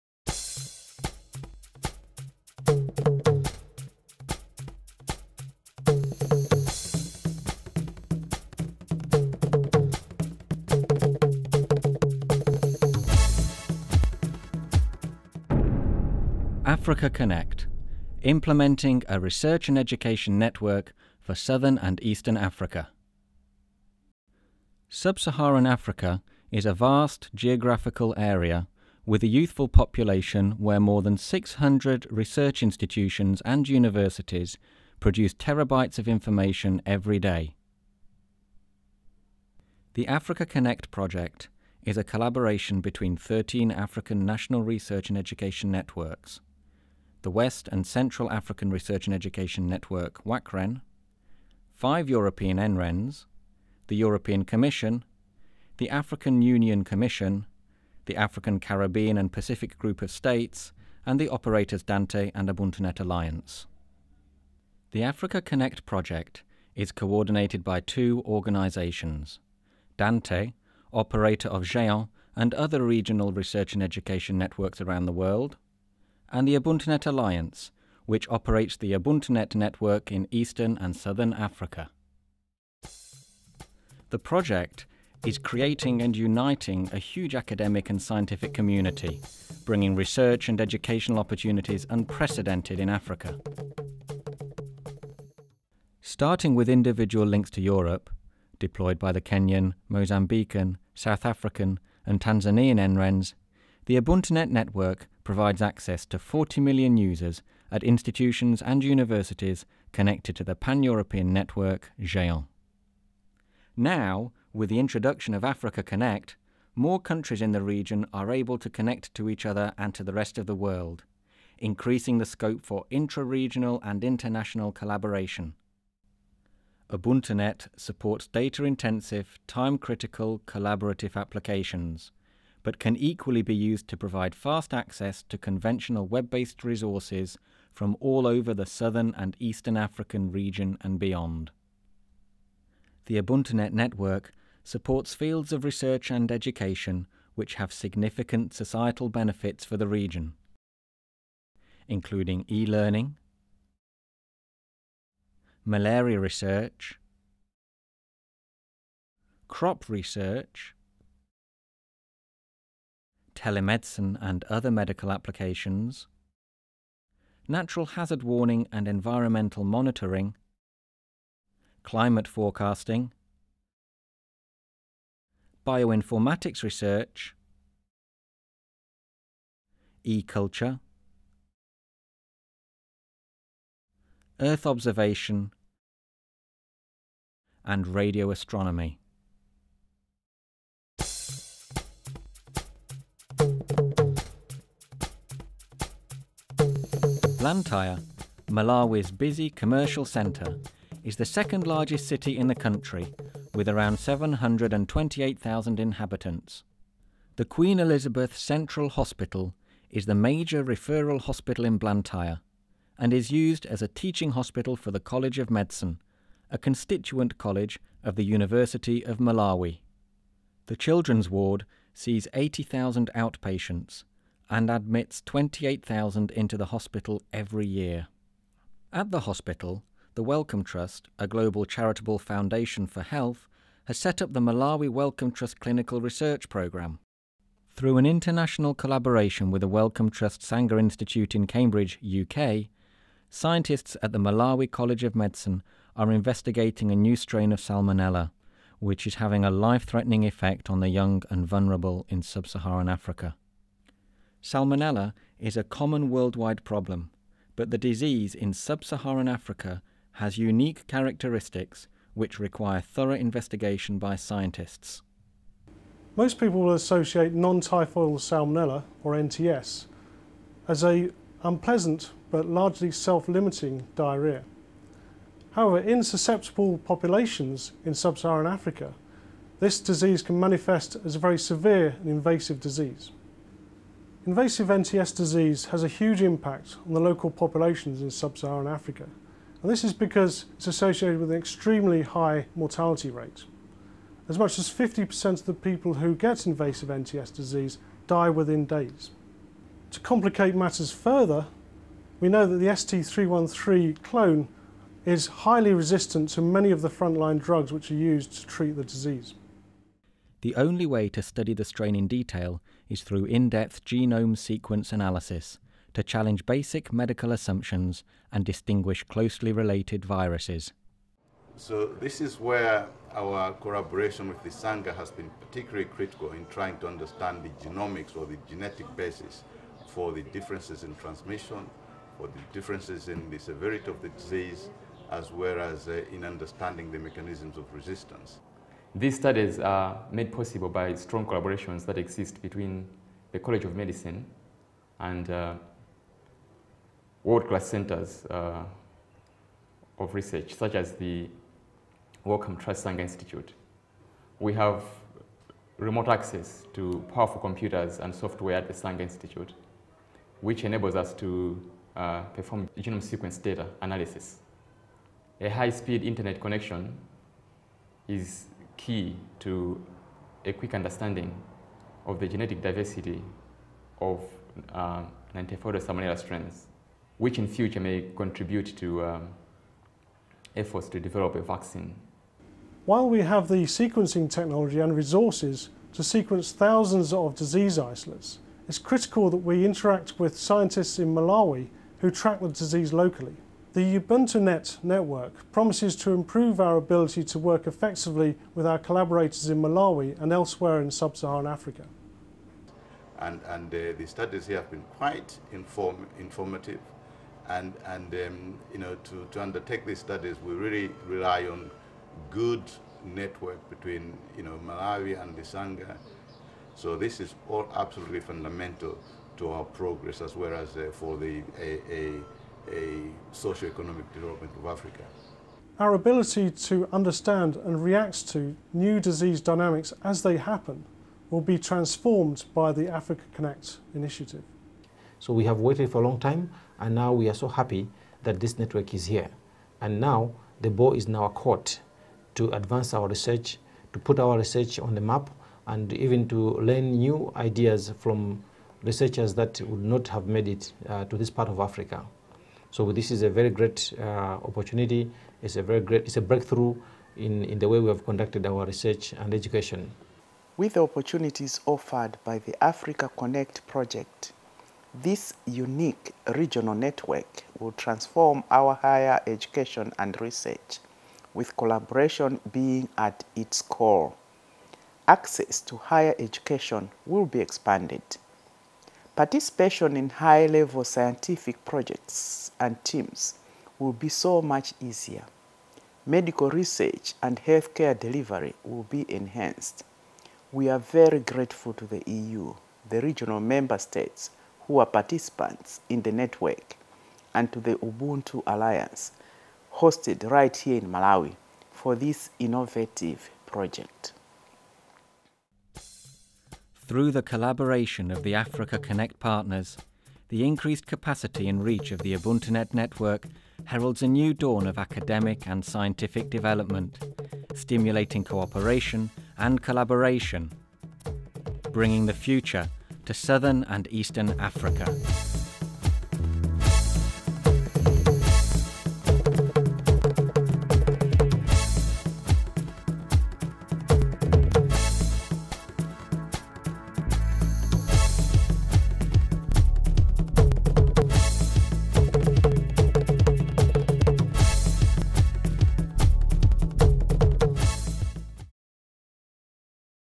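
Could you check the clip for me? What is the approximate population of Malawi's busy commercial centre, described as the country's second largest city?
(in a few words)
728,000.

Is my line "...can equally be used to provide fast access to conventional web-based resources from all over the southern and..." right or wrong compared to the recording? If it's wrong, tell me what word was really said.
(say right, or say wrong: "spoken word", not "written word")
right.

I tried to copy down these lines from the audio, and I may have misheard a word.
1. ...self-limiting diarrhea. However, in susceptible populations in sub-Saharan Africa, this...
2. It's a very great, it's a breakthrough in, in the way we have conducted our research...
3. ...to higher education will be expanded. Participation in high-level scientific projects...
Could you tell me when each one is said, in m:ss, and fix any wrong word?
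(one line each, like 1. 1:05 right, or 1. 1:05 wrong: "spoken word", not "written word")
1. 4:32 right
2. 7:35 right
3. 7:55 right.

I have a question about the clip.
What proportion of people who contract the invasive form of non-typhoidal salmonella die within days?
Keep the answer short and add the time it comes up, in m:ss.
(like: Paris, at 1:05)
50%, at 4:54.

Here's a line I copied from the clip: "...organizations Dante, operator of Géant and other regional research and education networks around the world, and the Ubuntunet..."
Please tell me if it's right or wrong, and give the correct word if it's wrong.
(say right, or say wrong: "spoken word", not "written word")
right.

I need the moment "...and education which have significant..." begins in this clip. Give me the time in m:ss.
2:26.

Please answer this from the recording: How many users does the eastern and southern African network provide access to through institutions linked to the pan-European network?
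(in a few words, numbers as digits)
40 million.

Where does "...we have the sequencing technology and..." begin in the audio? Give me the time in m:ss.
6:23.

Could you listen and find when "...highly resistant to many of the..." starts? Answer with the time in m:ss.
5:05.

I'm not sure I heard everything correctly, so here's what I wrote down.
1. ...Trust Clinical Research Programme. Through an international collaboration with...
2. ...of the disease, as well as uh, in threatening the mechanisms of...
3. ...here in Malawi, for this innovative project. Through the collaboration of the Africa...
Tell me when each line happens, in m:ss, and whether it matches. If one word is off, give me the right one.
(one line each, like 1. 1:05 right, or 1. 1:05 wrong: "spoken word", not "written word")
1. 3:55 right
2. 5:33 wrong: "understanding", not "threatening"
3. 8:20 right.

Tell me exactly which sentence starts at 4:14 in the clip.
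Salmonella is a common worldwide problem, but the disease in sub Saharan Africa has unique characteristics which require thorough investigation by scientists.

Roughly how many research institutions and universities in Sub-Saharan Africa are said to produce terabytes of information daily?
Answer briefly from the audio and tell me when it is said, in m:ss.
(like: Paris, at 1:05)
600, at 0:30.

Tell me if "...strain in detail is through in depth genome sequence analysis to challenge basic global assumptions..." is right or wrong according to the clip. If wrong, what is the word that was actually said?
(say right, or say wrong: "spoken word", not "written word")
wrong: "medical", not "global".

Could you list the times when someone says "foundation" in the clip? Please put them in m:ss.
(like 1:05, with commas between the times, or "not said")
3:52.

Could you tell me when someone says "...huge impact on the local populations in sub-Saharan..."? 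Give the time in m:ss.
4:45.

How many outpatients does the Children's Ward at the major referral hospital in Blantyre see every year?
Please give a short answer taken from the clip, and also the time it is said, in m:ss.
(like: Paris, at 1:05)
80,000, at 3:42.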